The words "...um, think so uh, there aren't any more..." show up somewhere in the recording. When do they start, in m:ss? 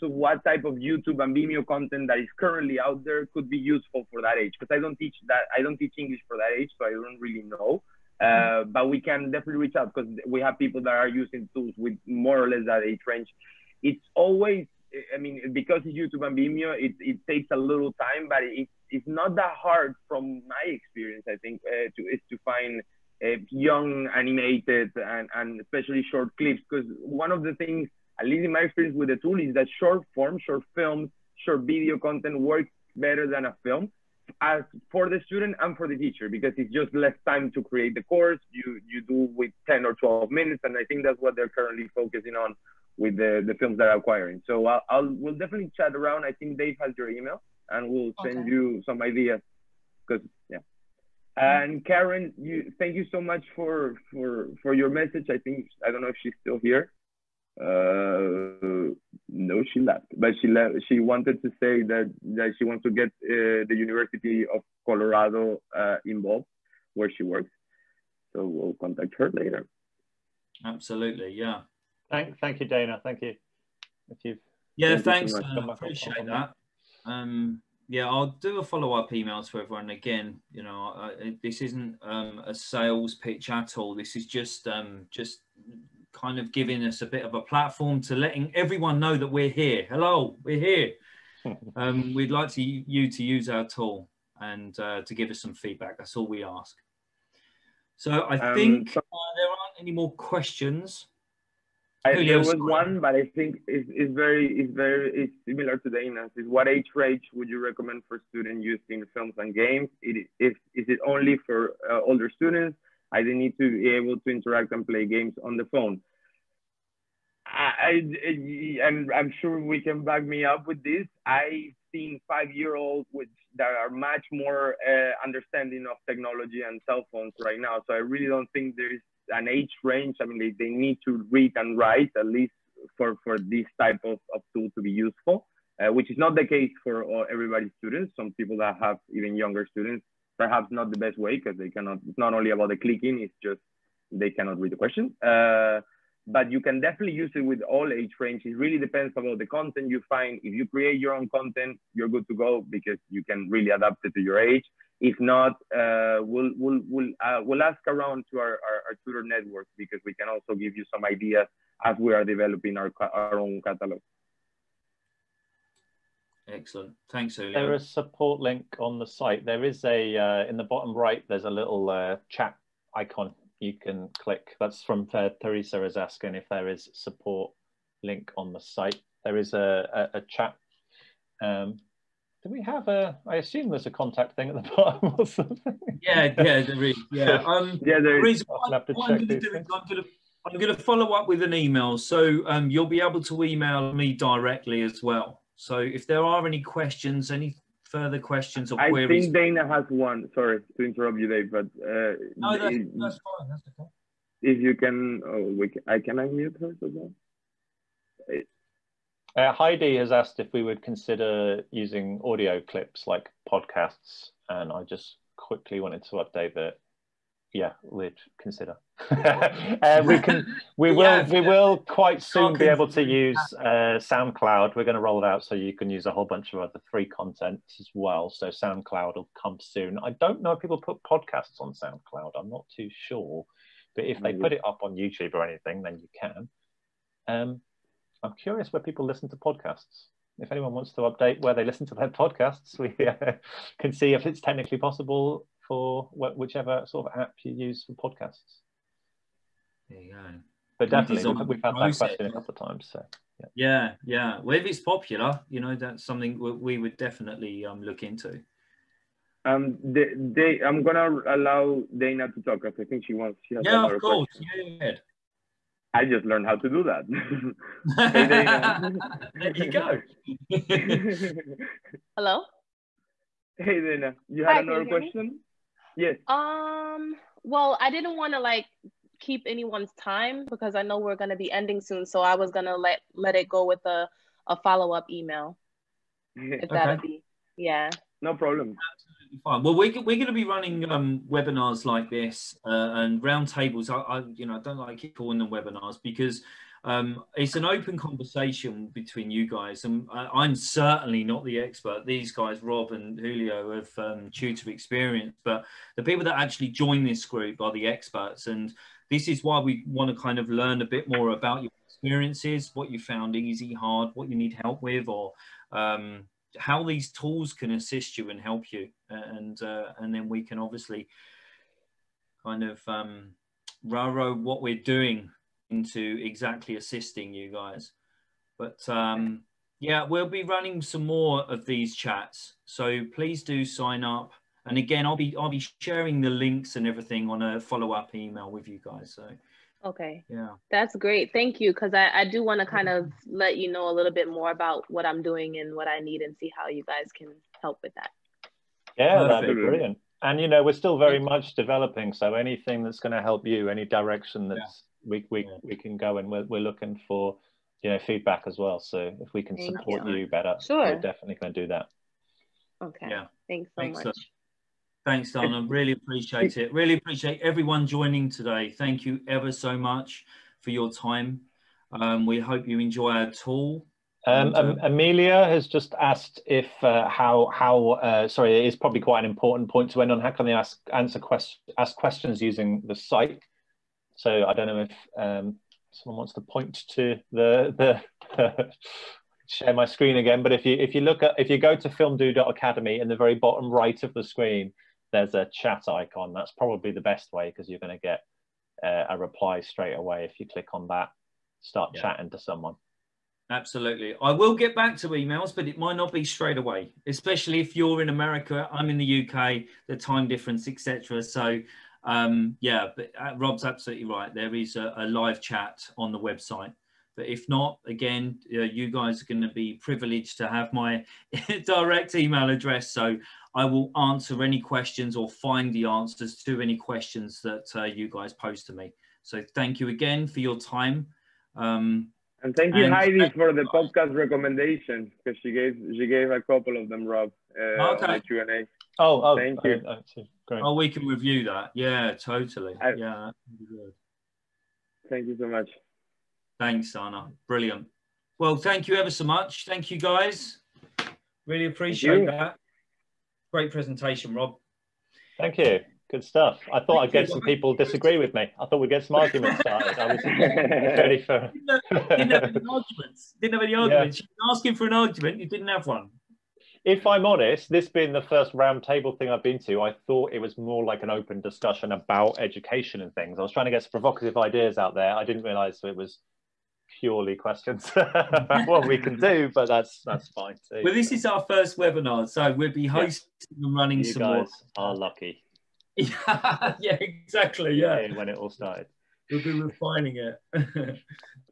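1:38.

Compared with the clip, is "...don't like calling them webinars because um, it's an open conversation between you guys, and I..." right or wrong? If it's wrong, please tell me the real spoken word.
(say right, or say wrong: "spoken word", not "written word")
right.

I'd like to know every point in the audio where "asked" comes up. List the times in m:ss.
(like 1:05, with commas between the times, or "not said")
3:30, 6:15.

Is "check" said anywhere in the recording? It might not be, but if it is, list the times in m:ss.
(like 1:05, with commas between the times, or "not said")
3:09.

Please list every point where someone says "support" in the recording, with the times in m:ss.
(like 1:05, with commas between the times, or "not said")
2:47, 2:56, 5:59.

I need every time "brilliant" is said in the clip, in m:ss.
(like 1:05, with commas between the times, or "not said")
5:49, 7:27.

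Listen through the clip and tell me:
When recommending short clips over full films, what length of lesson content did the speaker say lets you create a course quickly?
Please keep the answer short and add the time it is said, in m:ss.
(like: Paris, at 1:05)
10 or 12 minutes, at 0:39.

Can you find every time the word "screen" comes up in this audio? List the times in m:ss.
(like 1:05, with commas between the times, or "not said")
6:29, 6:34.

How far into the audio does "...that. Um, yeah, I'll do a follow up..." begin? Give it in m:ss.
1:16.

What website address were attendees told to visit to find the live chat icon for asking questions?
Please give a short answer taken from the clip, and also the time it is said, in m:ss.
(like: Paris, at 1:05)
filmdoo.academy, at 6:31.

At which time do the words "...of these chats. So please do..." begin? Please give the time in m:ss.
5:31.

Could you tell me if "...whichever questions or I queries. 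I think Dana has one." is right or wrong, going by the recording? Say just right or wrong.
wrong.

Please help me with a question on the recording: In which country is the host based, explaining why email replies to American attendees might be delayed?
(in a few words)
UK.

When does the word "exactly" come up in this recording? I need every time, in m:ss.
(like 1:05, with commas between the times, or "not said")
5:26, 8:07.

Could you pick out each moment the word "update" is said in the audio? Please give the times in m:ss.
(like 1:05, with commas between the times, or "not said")
3:36, 4:01.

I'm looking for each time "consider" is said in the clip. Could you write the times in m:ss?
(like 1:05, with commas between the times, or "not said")
3:30, 3:38.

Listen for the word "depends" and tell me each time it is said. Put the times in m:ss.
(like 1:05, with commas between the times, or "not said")
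2:28.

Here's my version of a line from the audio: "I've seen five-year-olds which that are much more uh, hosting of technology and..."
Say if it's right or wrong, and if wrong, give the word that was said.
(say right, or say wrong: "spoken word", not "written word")
wrong: "understanding", not "hosting".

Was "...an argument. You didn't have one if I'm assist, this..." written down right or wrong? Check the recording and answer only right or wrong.
wrong.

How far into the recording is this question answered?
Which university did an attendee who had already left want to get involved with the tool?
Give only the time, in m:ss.
1:03.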